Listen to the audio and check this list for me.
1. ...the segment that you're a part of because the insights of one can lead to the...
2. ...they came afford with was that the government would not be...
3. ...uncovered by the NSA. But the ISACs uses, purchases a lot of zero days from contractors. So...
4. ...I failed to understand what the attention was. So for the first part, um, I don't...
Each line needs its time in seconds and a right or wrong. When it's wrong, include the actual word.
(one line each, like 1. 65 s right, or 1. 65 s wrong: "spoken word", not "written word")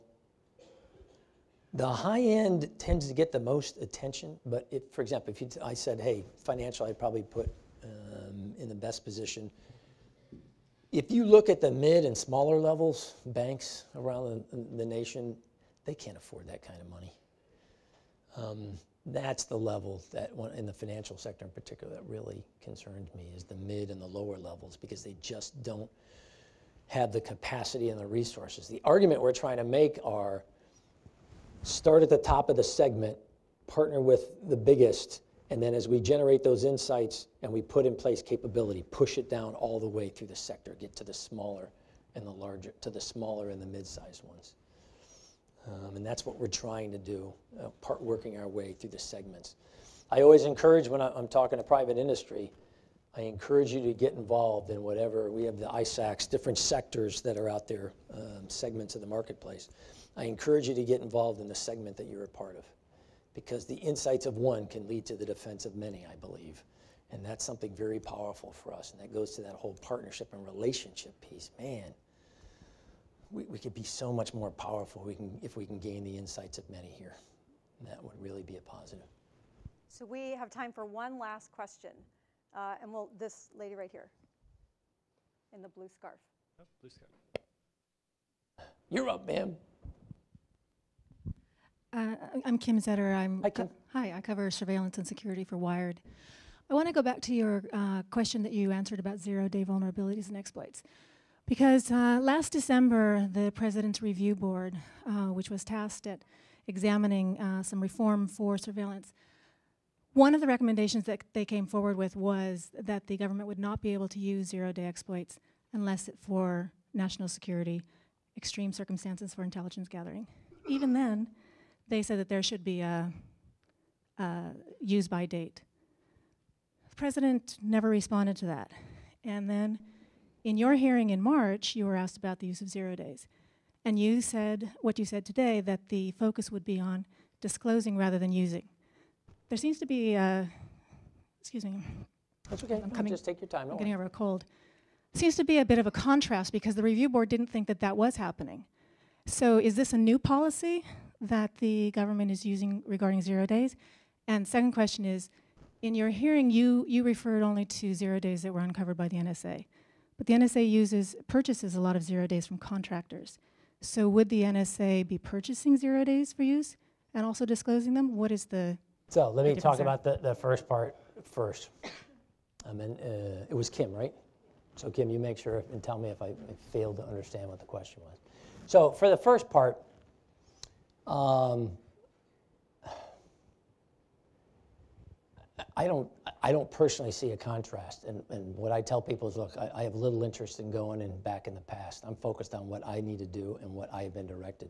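1. 61 s right
2. 111 s wrong: "forward", not "afford"
3. 158 s wrong: "NSA", not "ISACs"
4. 176 s wrong: "question", not "attention".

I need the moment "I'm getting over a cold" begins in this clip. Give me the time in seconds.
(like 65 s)
143 s.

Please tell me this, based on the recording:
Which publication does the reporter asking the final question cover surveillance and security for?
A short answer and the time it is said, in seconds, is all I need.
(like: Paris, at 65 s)
Wired, at 95 s.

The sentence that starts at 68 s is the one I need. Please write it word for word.
And that goes to that whole partnership and relationship piece.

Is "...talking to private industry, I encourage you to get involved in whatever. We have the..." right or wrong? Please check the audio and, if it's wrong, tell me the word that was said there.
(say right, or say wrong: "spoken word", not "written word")
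right.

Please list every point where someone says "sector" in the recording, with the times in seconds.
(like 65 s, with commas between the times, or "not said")
21 s, 40 s, 56 s.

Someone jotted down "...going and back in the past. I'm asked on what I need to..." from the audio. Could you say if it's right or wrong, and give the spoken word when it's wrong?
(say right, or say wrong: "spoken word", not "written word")
wrong: "focused", not "asked".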